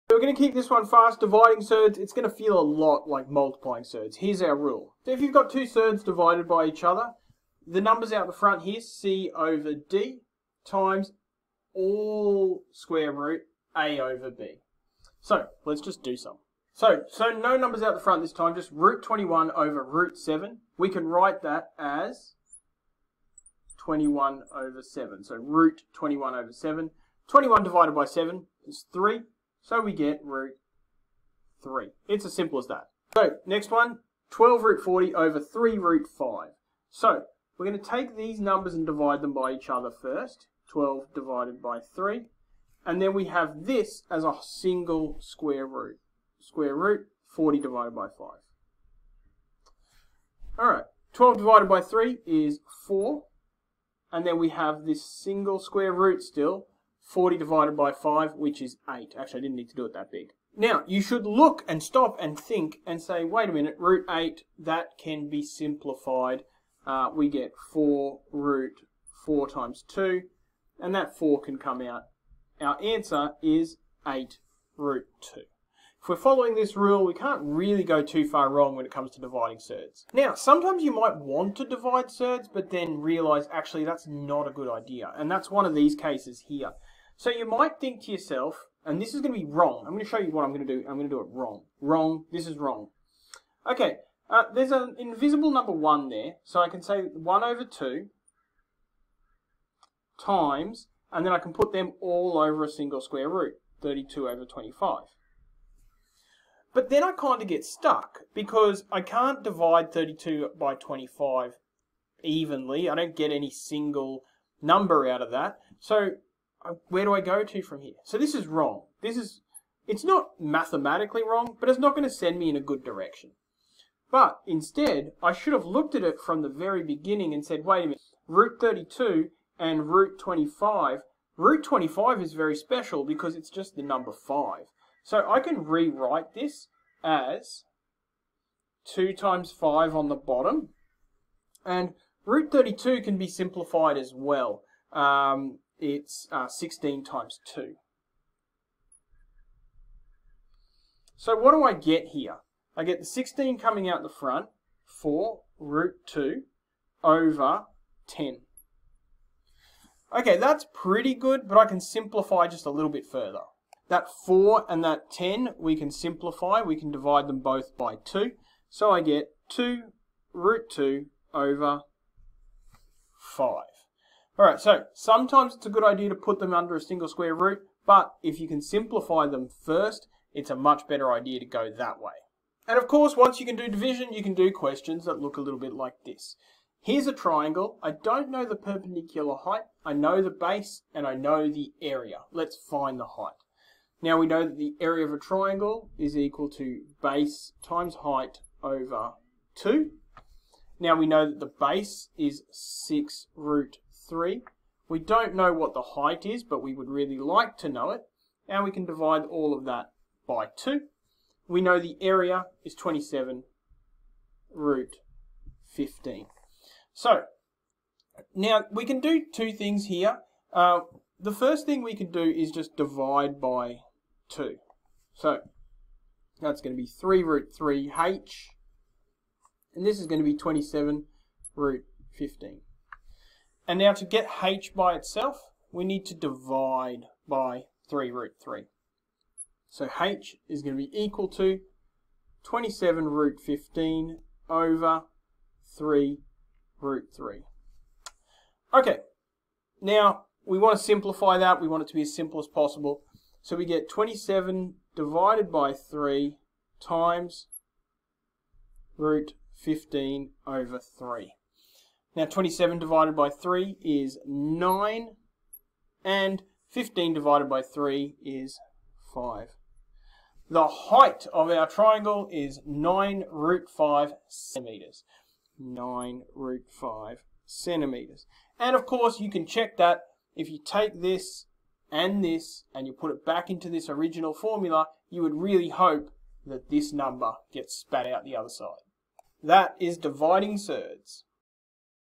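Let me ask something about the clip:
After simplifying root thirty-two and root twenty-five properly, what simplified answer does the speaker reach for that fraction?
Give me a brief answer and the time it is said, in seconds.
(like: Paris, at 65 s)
2 root 2 over 5, at 169 s.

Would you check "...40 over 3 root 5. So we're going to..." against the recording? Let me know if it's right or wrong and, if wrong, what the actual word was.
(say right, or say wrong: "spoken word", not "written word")
right.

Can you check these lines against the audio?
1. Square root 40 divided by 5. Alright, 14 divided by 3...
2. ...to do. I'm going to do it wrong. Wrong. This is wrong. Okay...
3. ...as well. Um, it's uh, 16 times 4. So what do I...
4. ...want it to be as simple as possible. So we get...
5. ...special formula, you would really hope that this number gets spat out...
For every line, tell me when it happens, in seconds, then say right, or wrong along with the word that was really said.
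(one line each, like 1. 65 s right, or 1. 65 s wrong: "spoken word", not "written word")
1. 46 s wrong: "12", not "14"
2. 90 s right
3. 143 s wrong: "2", not "4"
4. 251 s right
5. 283 s wrong: "original", not "special".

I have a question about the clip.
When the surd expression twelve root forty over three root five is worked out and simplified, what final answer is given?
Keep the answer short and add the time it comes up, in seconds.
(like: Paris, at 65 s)
8 root 2, at 74 s.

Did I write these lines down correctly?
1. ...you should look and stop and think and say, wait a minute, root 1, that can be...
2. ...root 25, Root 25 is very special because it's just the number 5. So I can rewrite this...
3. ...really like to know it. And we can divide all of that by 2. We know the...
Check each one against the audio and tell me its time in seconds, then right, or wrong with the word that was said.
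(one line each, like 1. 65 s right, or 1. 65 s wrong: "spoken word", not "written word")
1. 60 s wrong: "8", not "1"
2. 129 s right
3. 206 s right.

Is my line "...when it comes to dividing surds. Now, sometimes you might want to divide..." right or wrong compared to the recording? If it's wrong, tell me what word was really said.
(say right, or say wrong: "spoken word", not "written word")
right.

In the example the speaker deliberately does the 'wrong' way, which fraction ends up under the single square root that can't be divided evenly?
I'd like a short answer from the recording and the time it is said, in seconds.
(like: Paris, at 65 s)
32 over 25, at 103 s.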